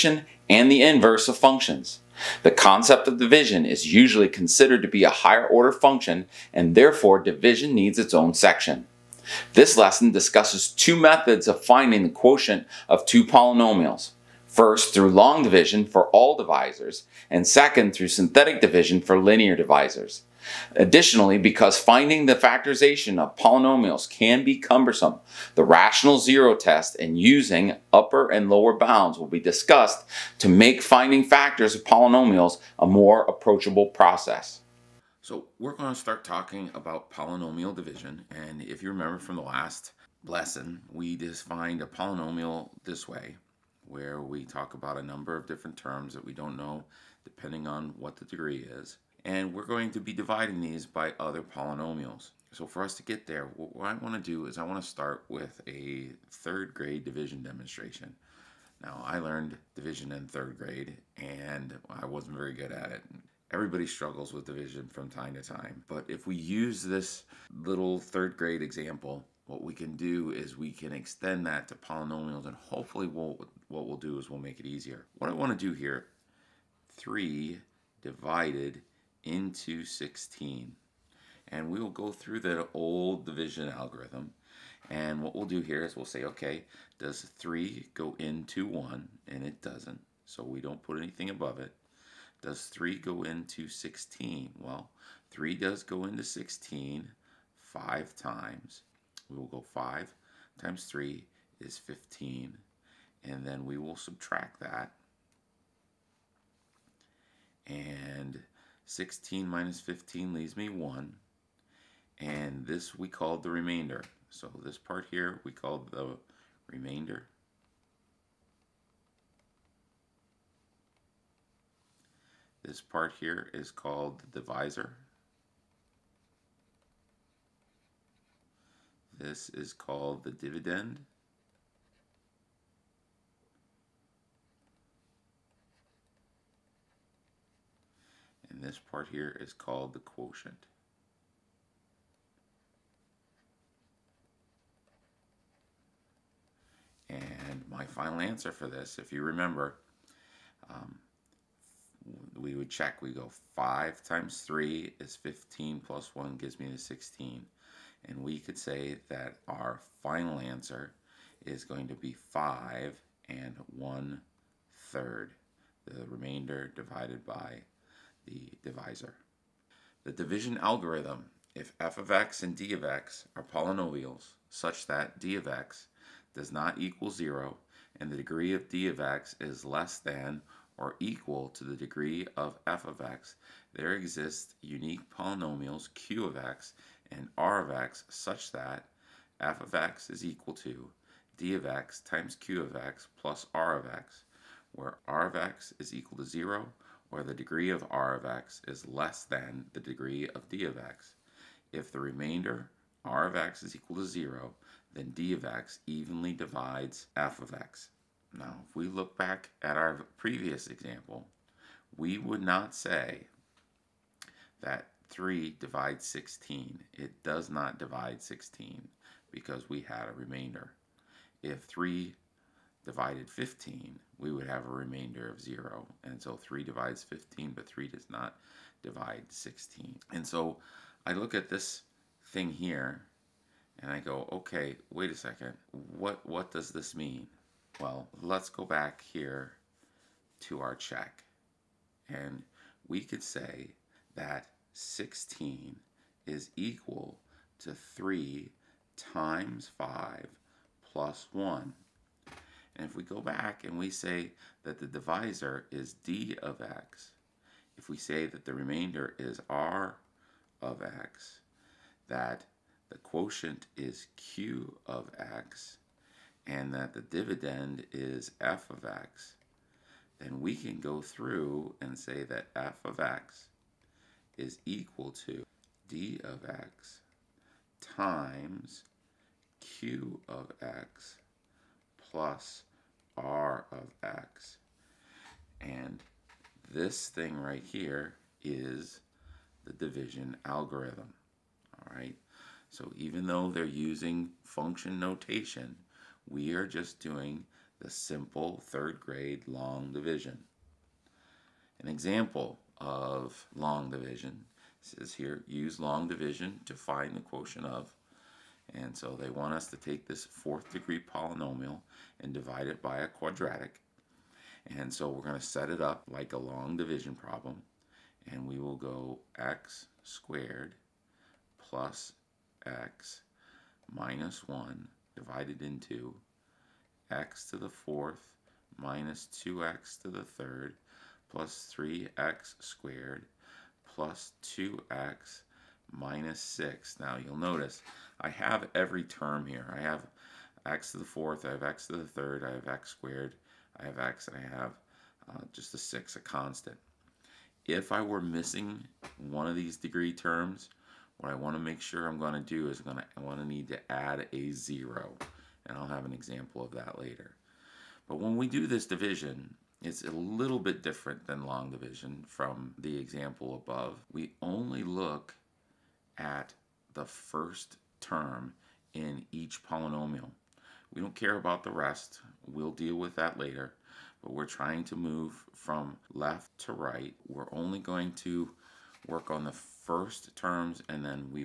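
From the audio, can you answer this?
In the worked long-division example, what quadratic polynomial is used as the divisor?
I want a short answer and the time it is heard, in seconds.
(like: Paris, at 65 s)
x^2 + x - 1, at 319 s.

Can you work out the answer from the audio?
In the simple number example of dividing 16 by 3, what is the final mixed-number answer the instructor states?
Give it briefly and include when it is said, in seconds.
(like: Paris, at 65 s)
5 and 1/3, at 162 s.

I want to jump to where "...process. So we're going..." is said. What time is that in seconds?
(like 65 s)
33 s.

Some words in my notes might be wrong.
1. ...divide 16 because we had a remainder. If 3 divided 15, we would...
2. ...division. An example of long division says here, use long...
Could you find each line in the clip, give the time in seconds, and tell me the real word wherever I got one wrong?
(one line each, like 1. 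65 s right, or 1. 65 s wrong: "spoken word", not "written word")
1. 217 s right
2. 299 s right.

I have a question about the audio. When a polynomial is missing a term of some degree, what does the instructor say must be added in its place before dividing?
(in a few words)
a 0.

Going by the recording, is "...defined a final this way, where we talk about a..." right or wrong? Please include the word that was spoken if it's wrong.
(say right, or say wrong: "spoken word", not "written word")
wrong: "polynomial", not "final".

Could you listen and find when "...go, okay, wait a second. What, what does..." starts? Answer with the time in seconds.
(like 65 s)
233 s.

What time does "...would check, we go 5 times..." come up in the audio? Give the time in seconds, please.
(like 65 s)
152 s.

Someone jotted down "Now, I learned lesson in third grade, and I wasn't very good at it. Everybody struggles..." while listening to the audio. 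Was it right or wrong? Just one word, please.
wrong.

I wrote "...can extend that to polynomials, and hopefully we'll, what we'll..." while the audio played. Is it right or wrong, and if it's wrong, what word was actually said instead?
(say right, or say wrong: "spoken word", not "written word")
right.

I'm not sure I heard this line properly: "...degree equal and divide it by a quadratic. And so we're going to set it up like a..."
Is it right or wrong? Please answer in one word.
wrong.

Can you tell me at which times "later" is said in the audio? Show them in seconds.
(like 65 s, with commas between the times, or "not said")
356 s, 373 s.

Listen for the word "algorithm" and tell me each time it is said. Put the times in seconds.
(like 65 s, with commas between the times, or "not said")
83 s, 170 s, 290 s.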